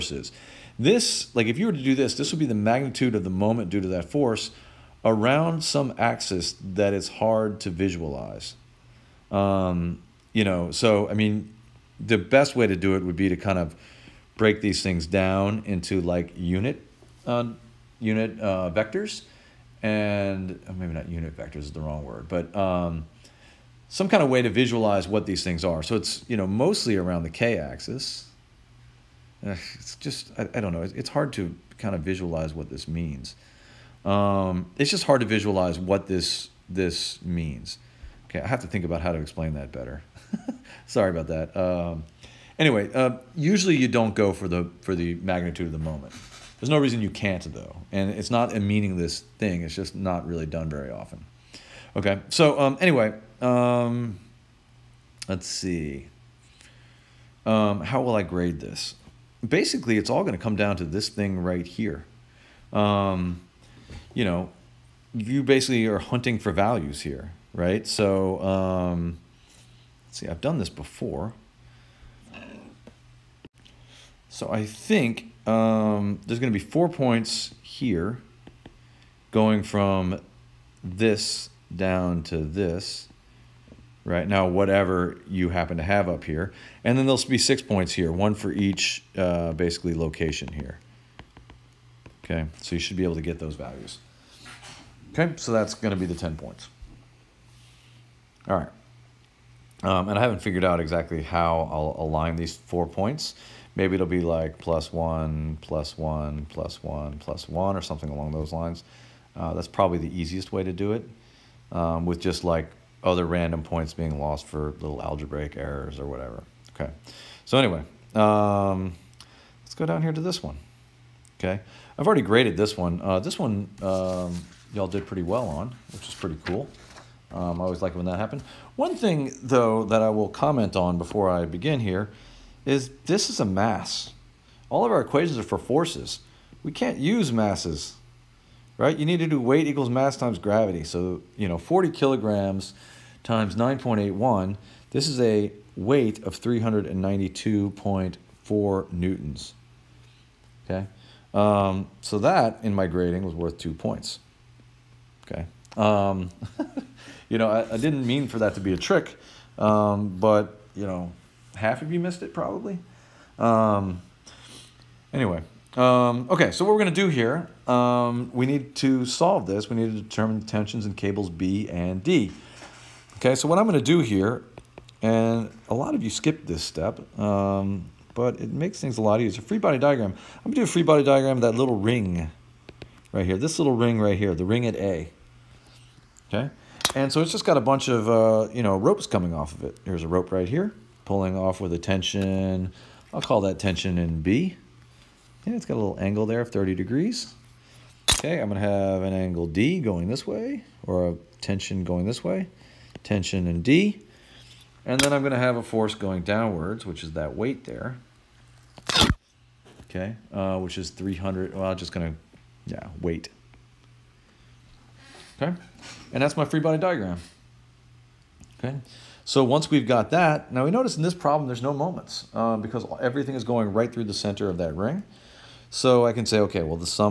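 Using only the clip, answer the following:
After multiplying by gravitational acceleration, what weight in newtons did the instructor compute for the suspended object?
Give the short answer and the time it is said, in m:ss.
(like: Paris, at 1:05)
392.4 newtons, at 2:26.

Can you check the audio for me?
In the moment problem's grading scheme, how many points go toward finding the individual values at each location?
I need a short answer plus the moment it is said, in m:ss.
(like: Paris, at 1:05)
6, at 1:27.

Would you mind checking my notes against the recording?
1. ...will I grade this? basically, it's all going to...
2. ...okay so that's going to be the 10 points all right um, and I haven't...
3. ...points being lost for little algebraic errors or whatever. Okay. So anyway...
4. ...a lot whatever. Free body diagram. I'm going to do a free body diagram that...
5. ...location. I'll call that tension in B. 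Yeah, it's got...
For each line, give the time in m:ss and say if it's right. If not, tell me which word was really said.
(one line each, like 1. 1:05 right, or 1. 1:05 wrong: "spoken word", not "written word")
1. 0:58 right
2. 1:35 right
3. 1:53 right
4. 2:58 wrong: "easier", not "whatever"
5. 3:11 wrong: "tension", not "location".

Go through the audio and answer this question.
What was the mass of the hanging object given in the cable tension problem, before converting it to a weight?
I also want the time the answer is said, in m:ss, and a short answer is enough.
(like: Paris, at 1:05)
40 kilograms, at 2:21.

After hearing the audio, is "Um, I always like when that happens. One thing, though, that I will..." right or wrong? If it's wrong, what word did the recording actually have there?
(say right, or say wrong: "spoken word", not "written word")
right.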